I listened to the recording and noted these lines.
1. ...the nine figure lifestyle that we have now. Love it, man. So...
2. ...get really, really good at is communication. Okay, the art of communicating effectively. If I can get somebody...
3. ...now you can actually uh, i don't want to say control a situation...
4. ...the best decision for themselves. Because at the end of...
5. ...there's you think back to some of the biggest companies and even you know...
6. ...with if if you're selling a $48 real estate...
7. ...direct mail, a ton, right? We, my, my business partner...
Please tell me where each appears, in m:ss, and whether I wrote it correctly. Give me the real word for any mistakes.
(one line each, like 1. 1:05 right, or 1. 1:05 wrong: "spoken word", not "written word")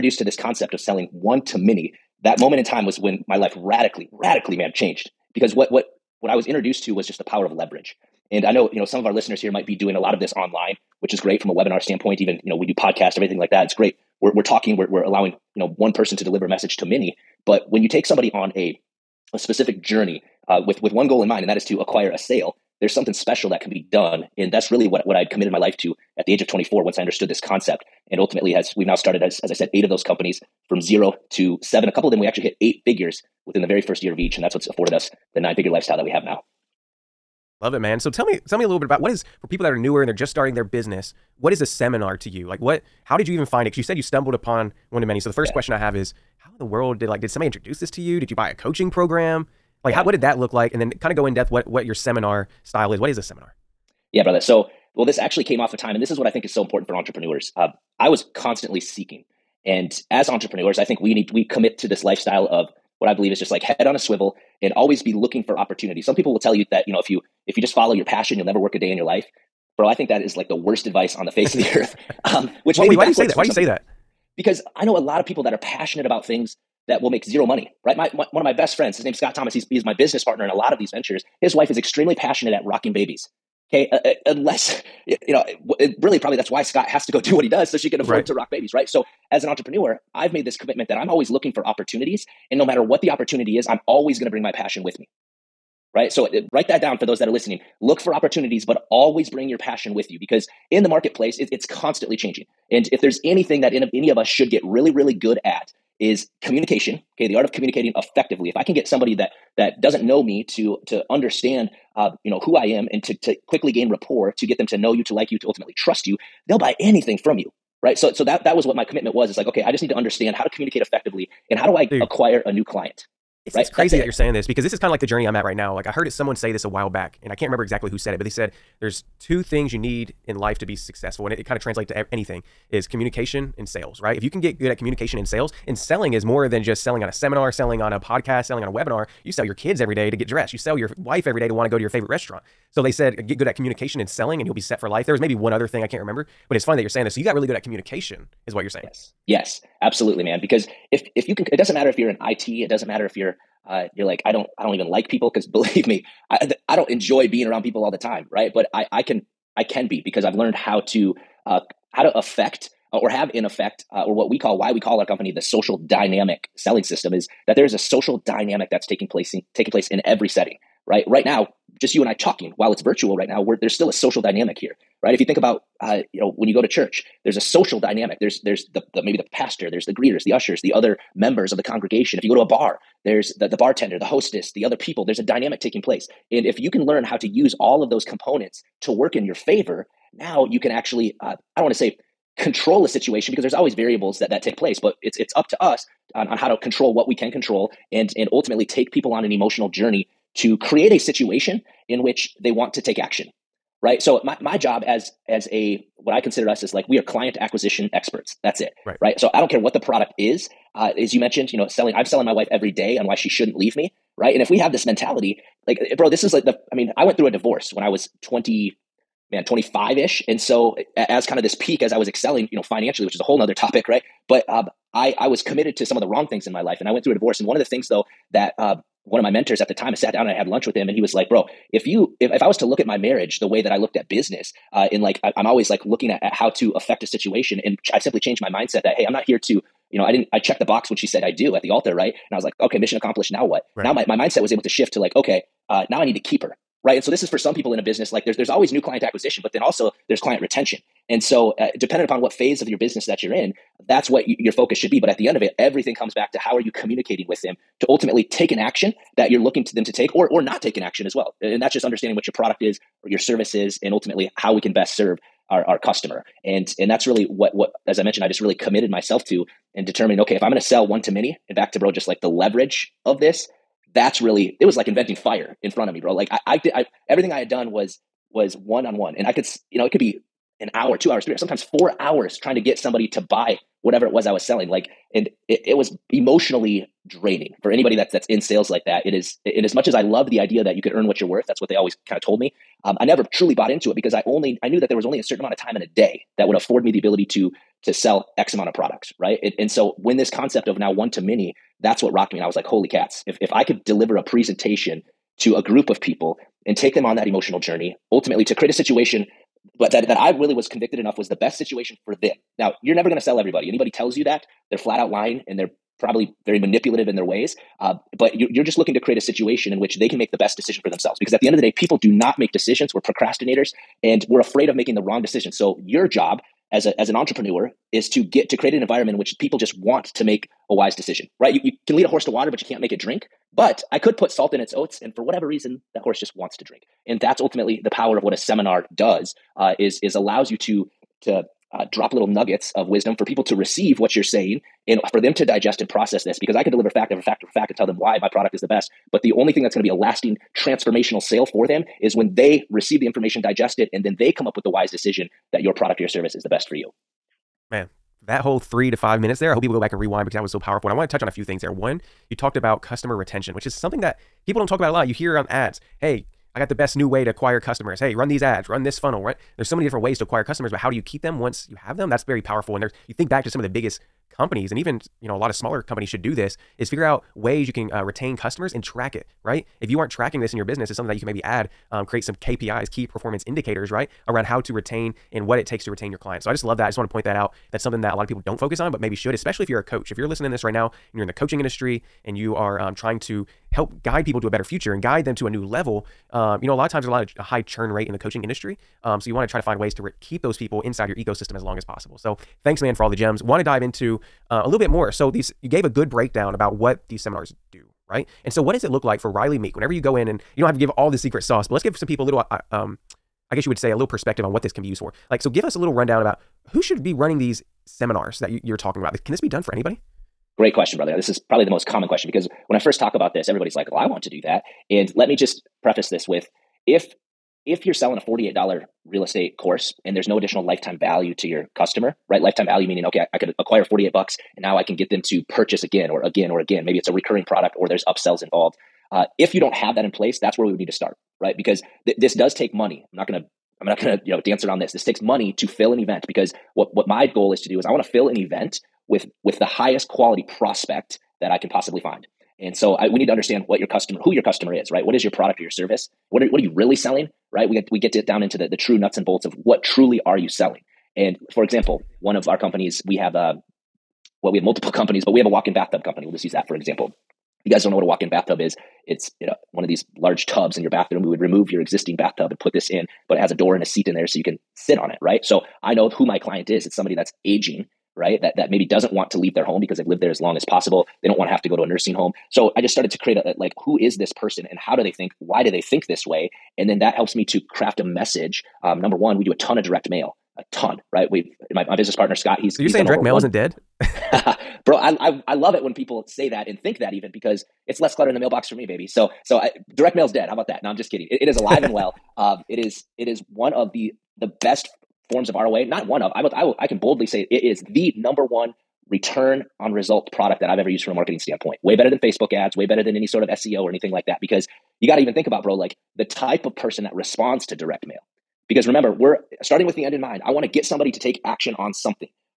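1. 0:35 right
2. 1:44 right
3. 3:10 right
4. 5:20 right
5. 6:12 right
6. 7:06 right
7. 8:09 right.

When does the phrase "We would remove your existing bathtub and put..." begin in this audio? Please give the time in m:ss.
7:51.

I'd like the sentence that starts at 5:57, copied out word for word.
Man, that whole three to five minutes there, I hope people go back and rewind because that was so powerful.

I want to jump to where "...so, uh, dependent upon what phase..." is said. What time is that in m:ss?
4:11.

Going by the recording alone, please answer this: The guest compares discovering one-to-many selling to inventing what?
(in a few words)
fire.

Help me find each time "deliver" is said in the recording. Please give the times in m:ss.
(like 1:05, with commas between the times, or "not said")
0:16, 5:03, 5:46.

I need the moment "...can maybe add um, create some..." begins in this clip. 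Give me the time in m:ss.
6:21.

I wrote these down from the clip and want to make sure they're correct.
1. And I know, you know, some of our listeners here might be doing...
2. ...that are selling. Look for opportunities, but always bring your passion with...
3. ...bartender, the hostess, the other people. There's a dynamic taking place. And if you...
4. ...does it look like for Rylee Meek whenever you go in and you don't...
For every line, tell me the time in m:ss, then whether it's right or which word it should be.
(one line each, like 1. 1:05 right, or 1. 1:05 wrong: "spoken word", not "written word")
1. 0:08 right
2. 1:37 wrong: "listening", not "selling"
3. 3:03 right
4. 6:48 right.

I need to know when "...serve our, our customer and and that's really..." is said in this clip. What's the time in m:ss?
4:24.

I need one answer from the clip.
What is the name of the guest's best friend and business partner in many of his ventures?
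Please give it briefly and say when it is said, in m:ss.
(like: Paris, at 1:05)
Scott Thomas, at 1:19.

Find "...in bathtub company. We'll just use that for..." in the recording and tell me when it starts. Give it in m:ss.
7:45.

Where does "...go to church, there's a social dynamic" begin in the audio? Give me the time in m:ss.
2:56.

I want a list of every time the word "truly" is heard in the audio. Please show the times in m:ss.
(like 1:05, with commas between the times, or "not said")
4:53, 7:39.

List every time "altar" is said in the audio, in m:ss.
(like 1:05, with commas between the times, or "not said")
4:01.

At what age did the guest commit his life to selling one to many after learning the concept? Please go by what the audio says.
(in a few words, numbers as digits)
24.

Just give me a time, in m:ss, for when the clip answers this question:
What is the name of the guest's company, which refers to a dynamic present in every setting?
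2:45.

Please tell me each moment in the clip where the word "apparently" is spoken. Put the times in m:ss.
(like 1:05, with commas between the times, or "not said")
not said.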